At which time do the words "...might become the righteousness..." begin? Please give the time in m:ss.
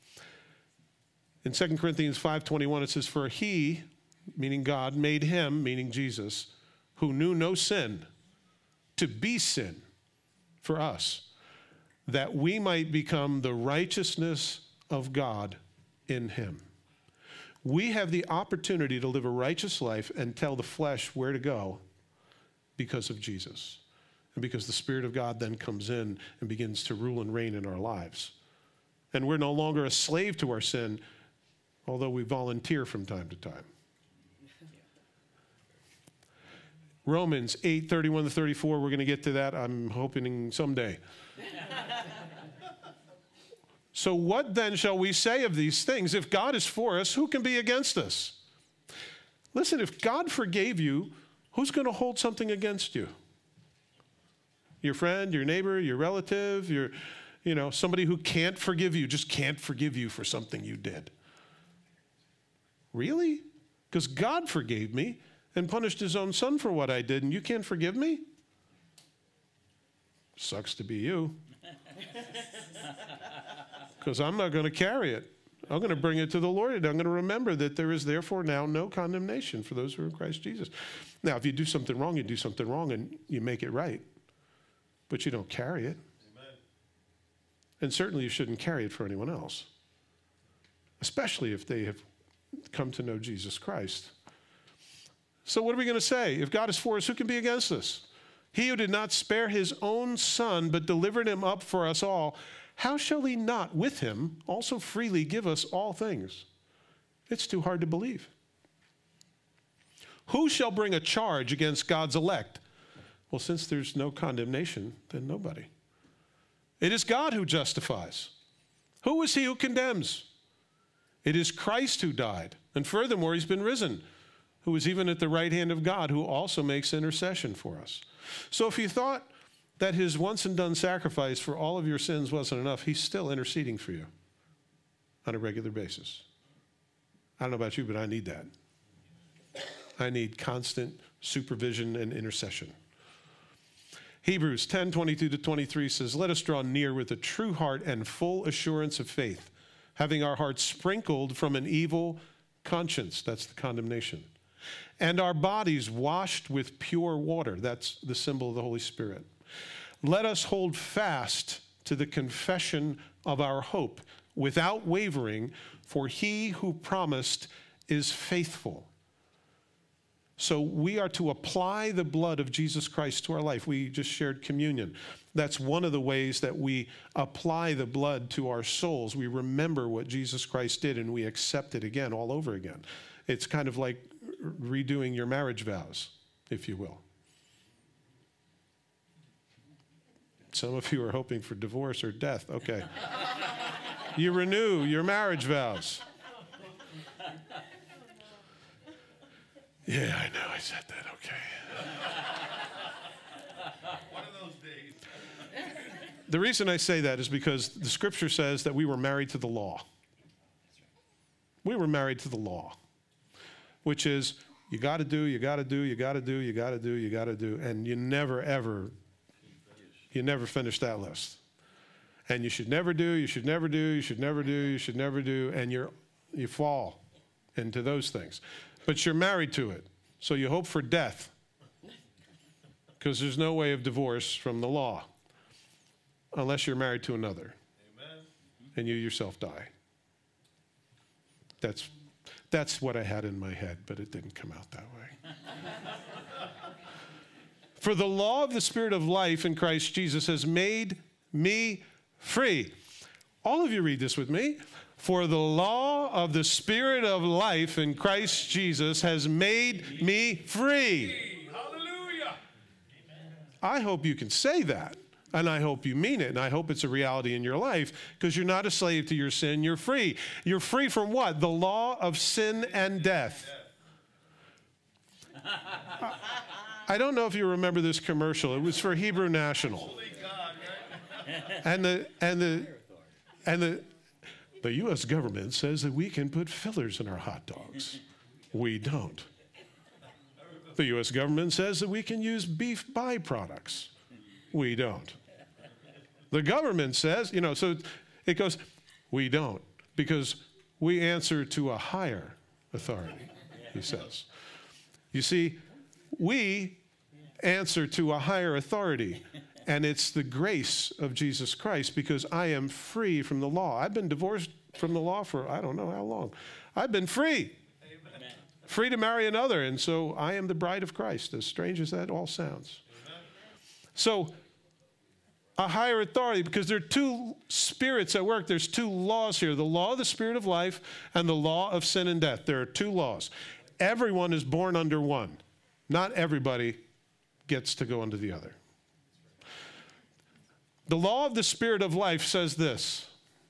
0:12.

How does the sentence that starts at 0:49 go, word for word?
Listen, if God forgave you, who's going to hold something against you?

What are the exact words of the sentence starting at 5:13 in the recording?
I've been divorced from the law for I don't know how long.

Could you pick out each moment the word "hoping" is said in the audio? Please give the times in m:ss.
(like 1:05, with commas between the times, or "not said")
0:39, 3:11.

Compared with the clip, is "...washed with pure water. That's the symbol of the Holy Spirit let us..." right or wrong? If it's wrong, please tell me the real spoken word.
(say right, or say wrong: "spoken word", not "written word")
right.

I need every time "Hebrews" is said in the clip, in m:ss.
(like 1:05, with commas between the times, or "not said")
2:24, 4:38.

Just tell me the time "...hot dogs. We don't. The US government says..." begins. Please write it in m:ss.
4:47.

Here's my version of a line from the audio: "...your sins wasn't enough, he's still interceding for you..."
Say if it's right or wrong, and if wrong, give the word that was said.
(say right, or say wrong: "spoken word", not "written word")
right.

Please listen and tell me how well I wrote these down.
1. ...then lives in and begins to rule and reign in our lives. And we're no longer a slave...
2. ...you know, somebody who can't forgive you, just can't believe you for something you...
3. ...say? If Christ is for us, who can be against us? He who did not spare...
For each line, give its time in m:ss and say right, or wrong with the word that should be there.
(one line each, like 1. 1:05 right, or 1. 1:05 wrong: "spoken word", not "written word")
1. 0:25 wrong: "comes", not "lives"
2. 0:57 wrong: "forgive", not "believe"
3. 1:35 wrong: "God", not "Christ".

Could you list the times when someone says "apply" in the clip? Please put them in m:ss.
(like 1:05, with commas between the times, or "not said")
2:51, 2:57.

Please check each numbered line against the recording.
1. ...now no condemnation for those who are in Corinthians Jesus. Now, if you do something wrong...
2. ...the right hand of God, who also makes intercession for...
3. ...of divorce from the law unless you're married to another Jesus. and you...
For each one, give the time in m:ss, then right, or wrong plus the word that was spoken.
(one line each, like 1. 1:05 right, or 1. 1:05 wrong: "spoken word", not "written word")
1. 1:18 wrong: "Christ", not "Corinthians"
2. 2:05 right
3. 3:53 wrong: "Amen", not "Jesus".